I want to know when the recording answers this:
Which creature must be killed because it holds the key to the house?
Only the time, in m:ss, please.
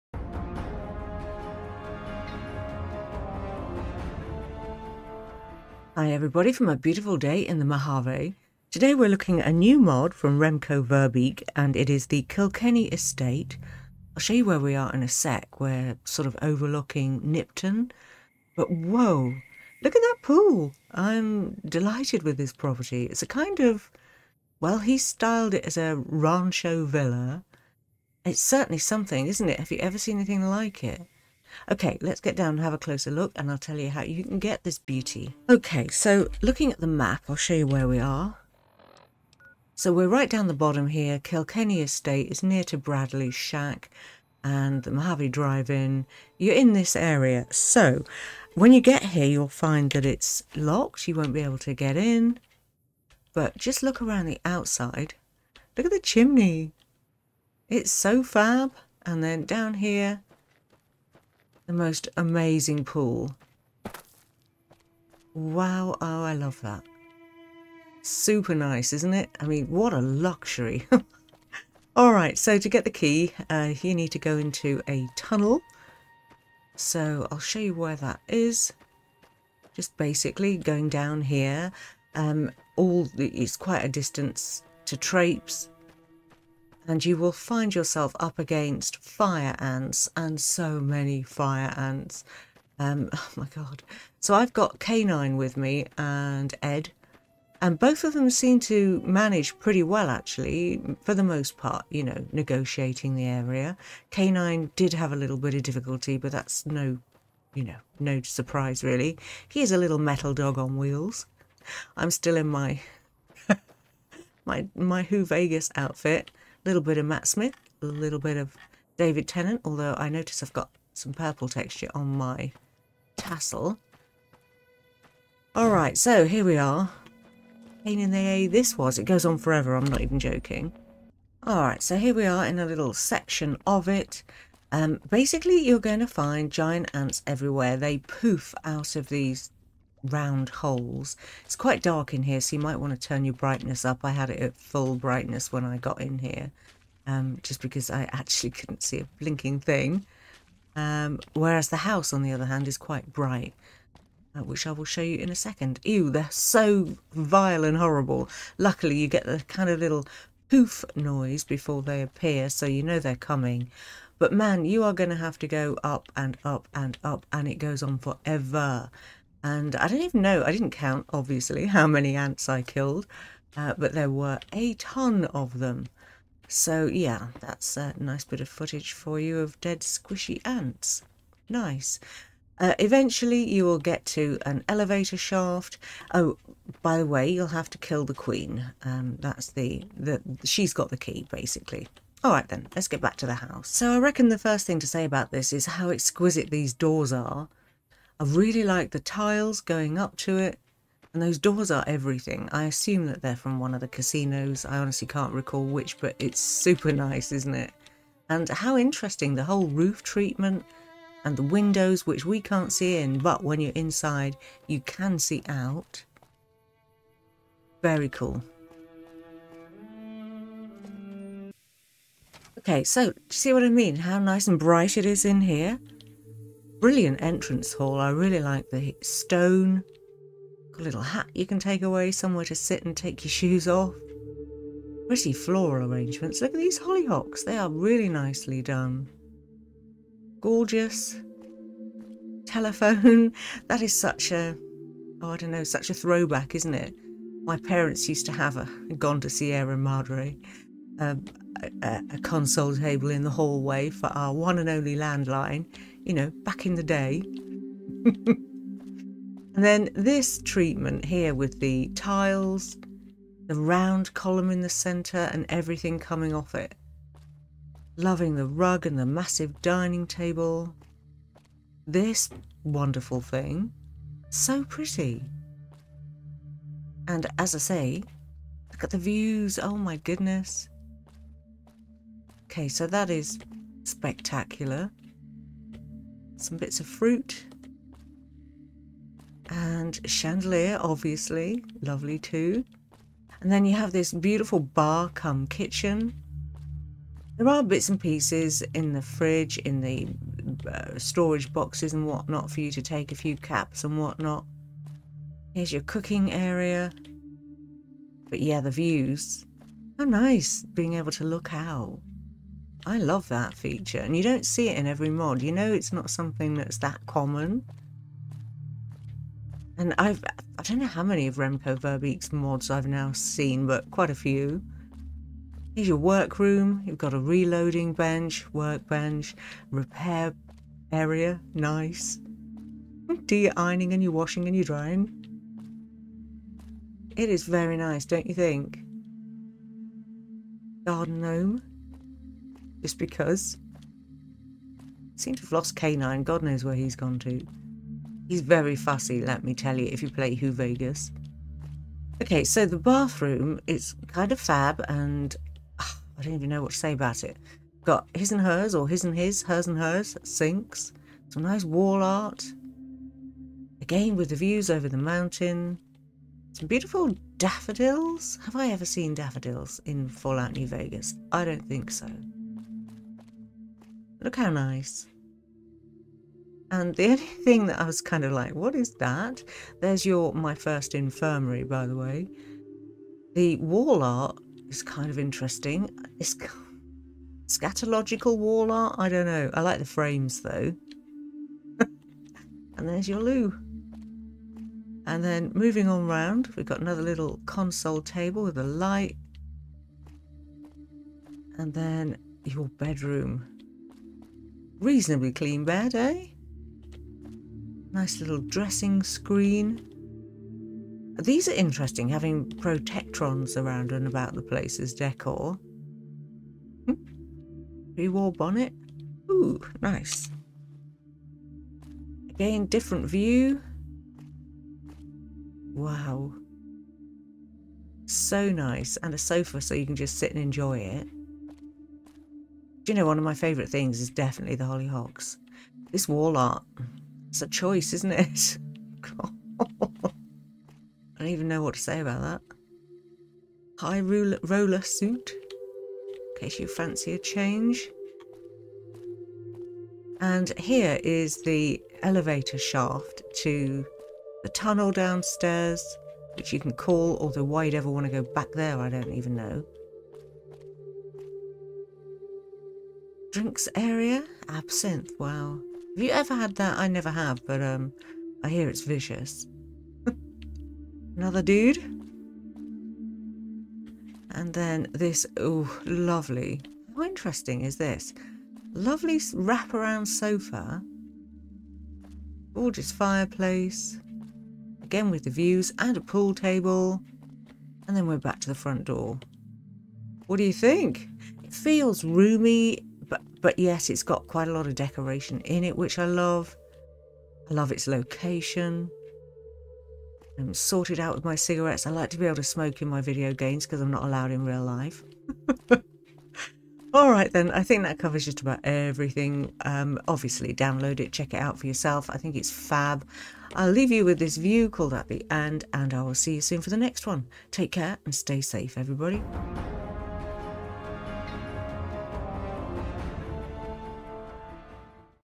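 3:08.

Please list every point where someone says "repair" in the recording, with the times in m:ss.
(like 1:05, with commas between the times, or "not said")
5:29.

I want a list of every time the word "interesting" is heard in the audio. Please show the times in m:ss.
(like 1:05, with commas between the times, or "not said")
3:28, 6:25, 6:51, 7:57.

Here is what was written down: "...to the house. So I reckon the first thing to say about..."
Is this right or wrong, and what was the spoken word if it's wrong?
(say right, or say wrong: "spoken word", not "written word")
right.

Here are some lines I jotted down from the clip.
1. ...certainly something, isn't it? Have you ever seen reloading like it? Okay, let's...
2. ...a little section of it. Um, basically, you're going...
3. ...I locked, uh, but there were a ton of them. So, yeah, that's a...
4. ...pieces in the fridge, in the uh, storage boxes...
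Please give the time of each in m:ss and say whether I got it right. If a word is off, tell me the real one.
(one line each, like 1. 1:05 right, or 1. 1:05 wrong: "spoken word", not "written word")
1. 0:28 wrong: "anything", not "reloading"
2. 2:12 right
3. 2:52 wrong: "killed", not "locked"
4. 4:57 right.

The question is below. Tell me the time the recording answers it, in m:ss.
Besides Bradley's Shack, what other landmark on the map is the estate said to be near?
0:44.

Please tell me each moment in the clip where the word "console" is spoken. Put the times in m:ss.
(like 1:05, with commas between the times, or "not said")
4:12, 6:37.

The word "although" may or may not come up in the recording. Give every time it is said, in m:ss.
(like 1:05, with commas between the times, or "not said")
1:59, 7:37.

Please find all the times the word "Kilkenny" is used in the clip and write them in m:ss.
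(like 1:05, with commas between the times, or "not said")
0:12, 0:41.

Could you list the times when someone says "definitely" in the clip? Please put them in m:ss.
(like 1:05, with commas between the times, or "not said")
7:14.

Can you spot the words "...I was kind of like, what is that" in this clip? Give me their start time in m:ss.
6:17.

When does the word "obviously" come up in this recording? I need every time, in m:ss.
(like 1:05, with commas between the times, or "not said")
2:51, 4:50, 8:30.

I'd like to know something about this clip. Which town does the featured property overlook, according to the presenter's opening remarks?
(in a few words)
Nipton.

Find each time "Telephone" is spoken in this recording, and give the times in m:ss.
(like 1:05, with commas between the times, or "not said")
4:02.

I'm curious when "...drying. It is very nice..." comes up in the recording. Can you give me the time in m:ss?
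5:34.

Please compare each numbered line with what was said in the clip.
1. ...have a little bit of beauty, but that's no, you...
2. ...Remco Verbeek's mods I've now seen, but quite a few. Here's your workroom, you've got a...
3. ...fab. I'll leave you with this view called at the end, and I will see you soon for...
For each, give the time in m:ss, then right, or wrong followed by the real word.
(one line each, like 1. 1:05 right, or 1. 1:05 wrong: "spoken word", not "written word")
1. 1:44 wrong: "difficulty", not "beauty"
2. 5:21 right
3. 8:32 right.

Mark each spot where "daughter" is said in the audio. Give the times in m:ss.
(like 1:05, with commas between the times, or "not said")
not said.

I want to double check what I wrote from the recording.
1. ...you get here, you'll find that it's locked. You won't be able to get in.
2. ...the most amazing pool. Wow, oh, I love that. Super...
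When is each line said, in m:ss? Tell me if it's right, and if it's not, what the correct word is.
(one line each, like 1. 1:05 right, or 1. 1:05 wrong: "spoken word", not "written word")
1. 0:48 right
2. 1:01 right.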